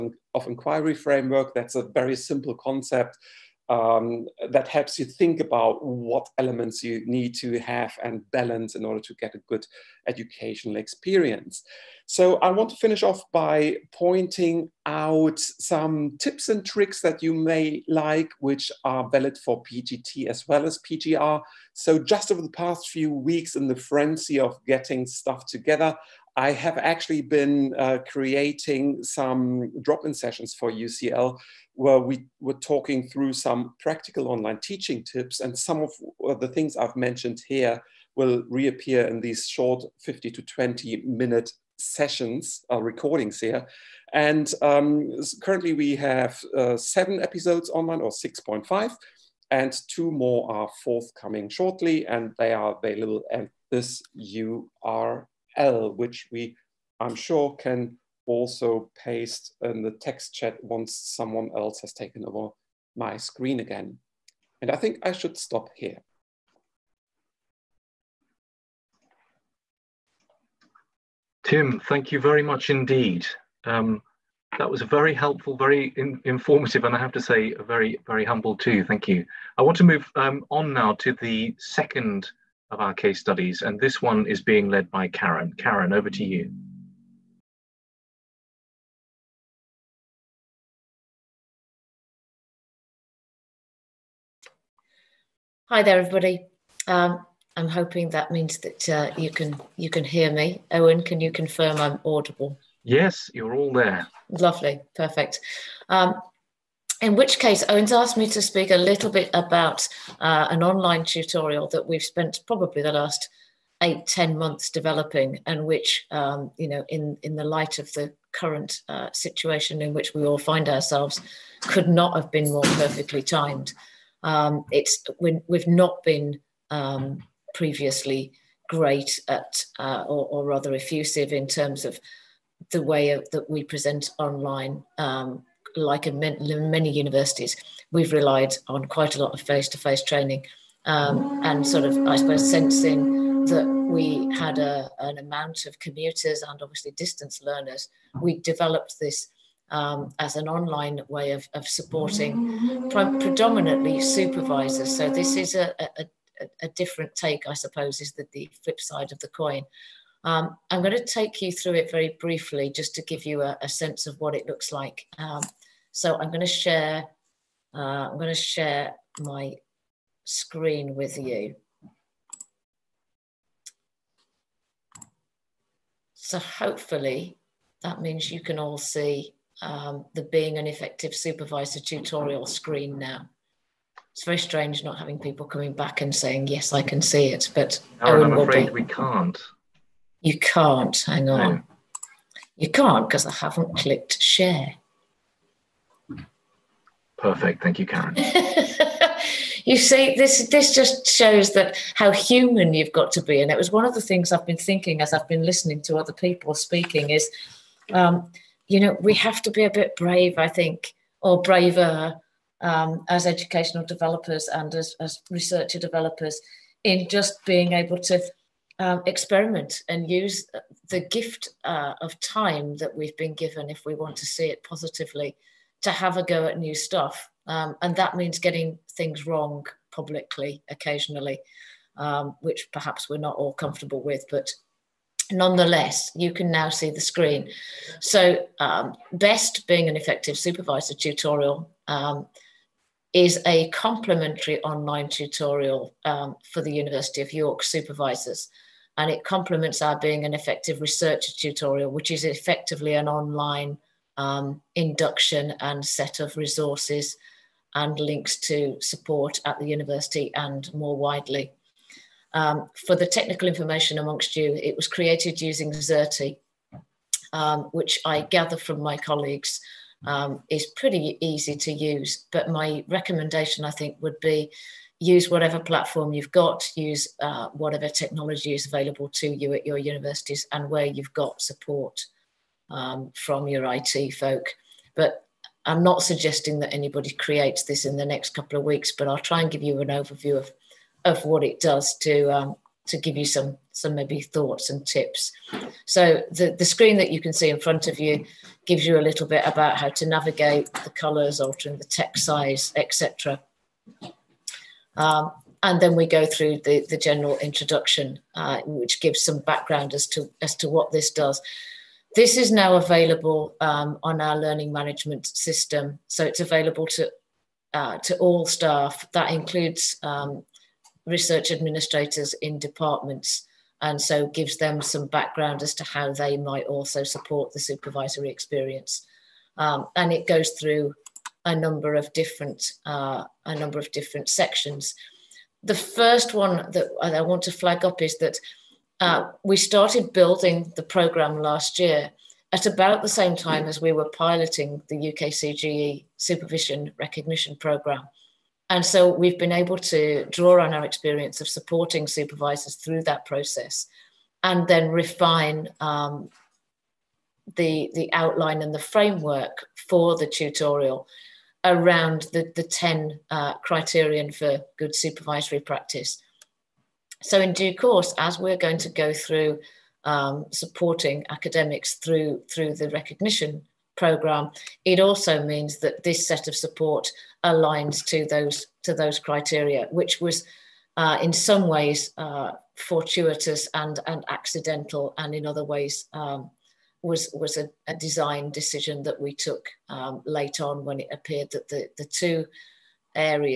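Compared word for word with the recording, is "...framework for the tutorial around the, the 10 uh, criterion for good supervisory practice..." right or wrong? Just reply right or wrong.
right.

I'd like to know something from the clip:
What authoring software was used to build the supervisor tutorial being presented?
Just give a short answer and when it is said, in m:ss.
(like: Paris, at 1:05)
Xerte, at 4:25.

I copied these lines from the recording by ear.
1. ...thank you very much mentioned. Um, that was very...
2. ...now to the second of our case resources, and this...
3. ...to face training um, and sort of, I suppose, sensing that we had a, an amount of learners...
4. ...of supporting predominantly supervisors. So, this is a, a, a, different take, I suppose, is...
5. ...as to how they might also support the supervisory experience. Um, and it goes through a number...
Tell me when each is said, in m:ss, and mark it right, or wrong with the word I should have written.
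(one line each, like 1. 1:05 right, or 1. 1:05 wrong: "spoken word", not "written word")
1. 1:11 wrong: "indeed", not "mentioned"
2. 1:20 wrong: "studies", not "resources"
3. 2:19 wrong: "commuters", not "learners"
4. 2:31 right
5. 5:25 right.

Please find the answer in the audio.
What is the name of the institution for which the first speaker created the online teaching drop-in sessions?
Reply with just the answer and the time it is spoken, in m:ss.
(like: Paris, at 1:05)
UCL, at 0:30.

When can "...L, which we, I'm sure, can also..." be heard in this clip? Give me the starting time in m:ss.
0:55.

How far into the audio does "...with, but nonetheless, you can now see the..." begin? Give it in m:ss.
3:54.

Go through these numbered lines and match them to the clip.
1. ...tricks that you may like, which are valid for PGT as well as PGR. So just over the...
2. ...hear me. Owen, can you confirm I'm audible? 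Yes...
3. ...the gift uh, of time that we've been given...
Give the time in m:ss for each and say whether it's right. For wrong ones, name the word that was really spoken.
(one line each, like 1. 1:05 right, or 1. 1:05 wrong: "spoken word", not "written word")
1. 0:16 right
2. 1:40 right
3. 3:40 right.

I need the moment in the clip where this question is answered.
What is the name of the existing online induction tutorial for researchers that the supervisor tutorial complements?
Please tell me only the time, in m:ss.
4:09.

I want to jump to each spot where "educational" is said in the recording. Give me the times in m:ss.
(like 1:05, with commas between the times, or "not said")
0:10, 3:33.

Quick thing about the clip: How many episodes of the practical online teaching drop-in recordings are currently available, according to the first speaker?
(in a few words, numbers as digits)
7.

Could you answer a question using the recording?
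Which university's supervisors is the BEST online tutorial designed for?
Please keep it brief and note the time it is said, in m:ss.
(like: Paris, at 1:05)
University of York, at 4:06.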